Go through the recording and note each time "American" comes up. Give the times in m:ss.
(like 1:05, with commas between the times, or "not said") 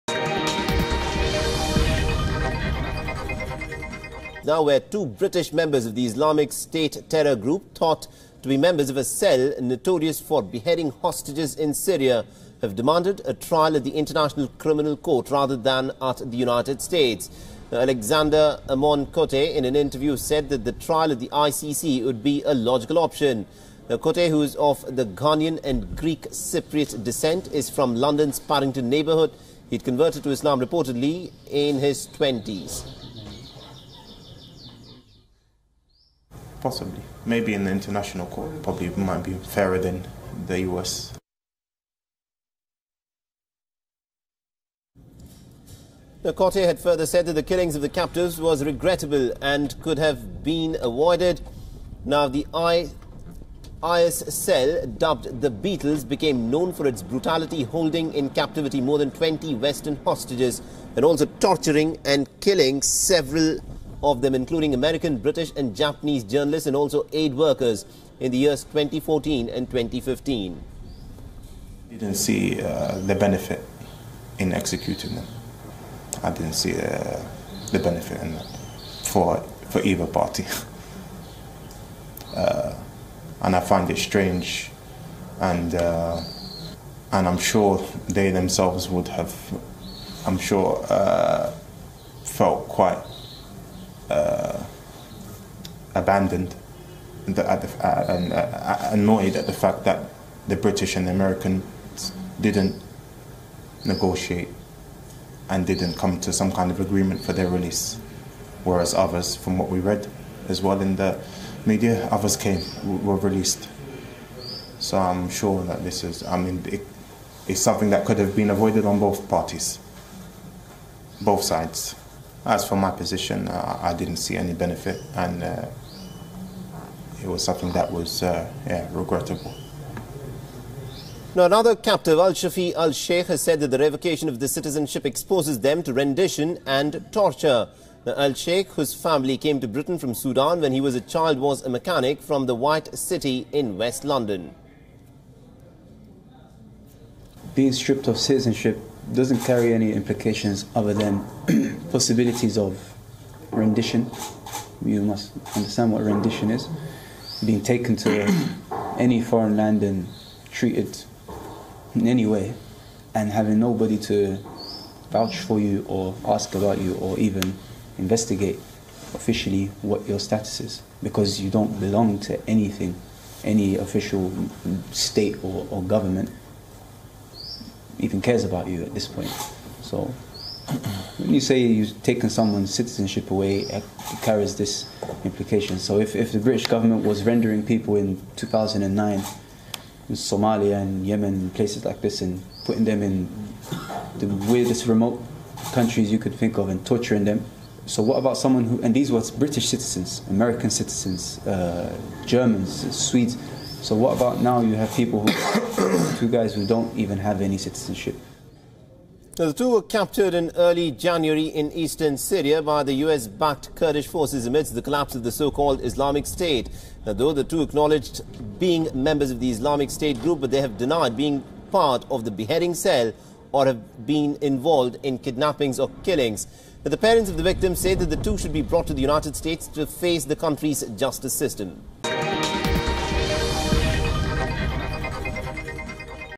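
1:04, 1:41, 3:20.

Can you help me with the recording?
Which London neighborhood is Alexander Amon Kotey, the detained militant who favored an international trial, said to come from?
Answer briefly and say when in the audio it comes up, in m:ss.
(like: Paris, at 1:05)
Paddington, at 0:28.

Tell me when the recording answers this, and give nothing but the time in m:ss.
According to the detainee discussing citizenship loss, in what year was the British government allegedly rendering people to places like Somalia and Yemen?
3:08.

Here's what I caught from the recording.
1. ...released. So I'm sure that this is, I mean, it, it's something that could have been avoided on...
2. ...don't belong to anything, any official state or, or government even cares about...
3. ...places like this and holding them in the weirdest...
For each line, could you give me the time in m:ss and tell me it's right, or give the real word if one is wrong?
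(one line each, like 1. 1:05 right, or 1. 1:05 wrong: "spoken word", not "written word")
1. 1:53 right
2. 2:51 right
3. 3:11 wrong: "putting", not "holding".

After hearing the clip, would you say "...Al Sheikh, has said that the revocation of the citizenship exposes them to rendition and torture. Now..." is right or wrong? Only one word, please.
right.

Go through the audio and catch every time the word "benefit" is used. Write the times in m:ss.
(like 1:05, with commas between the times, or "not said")
1:13, 1:17, 2:04.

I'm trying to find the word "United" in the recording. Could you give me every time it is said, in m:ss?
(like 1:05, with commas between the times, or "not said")
0:16, 3:49.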